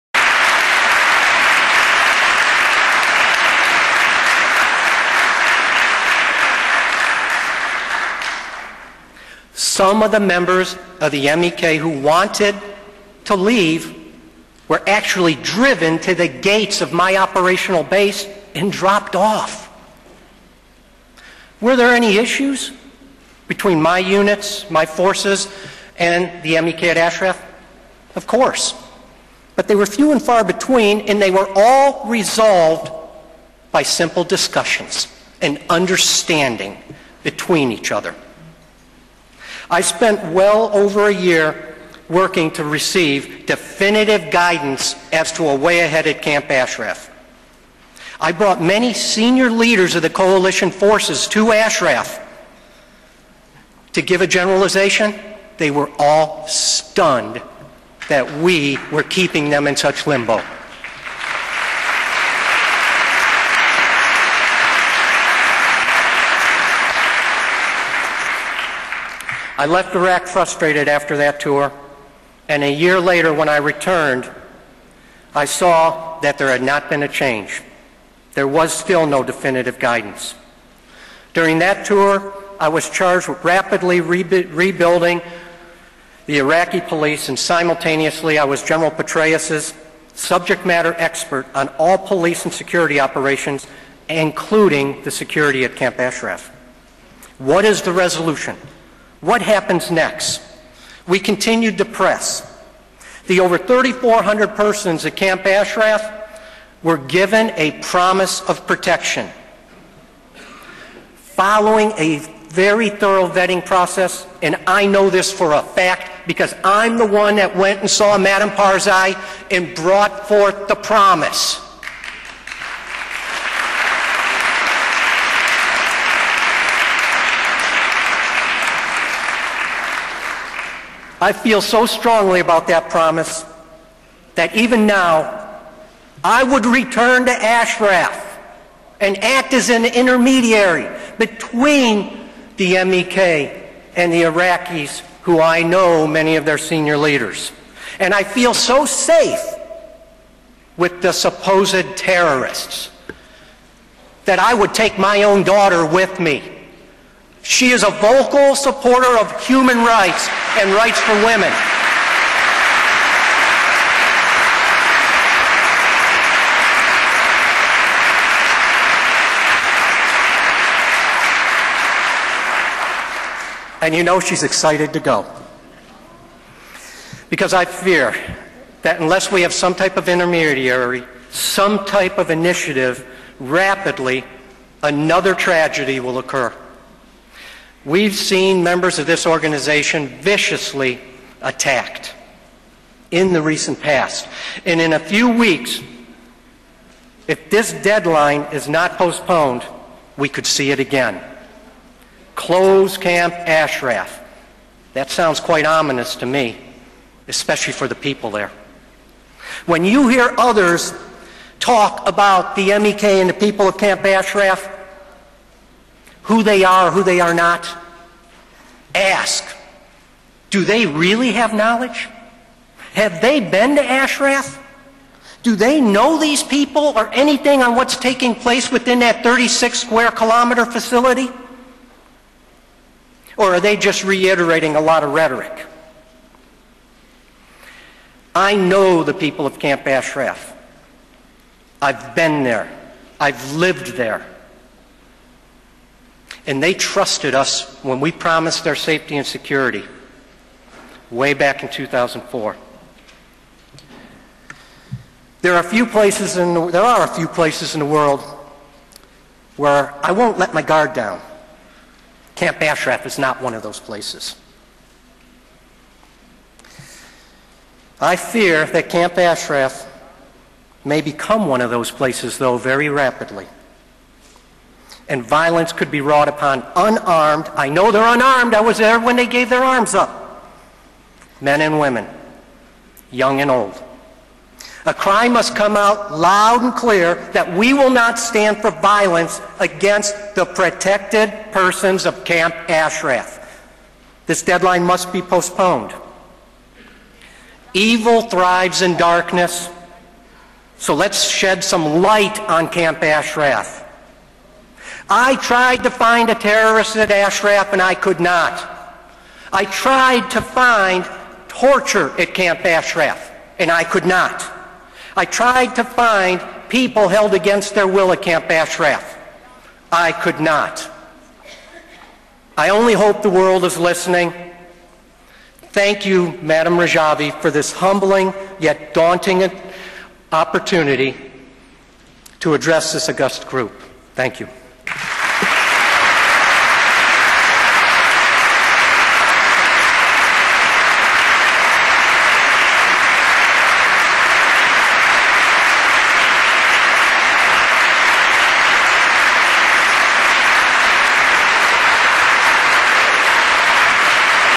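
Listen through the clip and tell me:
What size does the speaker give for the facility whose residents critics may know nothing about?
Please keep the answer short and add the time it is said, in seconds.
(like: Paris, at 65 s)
36 square kilometers, at 229 s.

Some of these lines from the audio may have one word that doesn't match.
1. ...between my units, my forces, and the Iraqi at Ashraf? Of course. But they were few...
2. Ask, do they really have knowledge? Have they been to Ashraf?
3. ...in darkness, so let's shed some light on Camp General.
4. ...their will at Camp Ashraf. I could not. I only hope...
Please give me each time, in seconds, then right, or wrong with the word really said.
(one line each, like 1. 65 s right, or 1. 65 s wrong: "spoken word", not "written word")
1. 23 s wrong: "MEK", not "Iraqi"
2. 218 s right
3. 298 s wrong: "Ashraf", not "General"
4. 317 s right.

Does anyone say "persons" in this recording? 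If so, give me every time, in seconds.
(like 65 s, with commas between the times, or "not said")
104 s, 291 s.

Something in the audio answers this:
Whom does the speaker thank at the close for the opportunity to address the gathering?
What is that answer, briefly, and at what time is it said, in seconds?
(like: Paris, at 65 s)
Madam Rajavi, at 326 s.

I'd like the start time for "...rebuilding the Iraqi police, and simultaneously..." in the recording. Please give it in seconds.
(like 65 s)
84 s.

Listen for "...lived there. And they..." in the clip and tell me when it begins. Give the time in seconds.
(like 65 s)
243 s.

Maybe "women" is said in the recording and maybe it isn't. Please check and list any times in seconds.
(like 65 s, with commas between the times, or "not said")
161 s, 281 s.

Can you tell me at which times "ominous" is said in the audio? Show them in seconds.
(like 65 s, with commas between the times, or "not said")
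205 s.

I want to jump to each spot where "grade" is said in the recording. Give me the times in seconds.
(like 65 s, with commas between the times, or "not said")
not said.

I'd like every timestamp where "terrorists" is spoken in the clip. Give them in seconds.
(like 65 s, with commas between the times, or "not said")
151 s, 306 s.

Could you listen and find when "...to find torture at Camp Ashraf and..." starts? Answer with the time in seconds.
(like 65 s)
310 s.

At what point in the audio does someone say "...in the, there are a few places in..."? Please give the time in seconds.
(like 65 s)
256 s.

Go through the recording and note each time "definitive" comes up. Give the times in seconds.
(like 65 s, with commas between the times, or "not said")
43 s, 79 s.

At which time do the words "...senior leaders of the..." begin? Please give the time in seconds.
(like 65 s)
48 s.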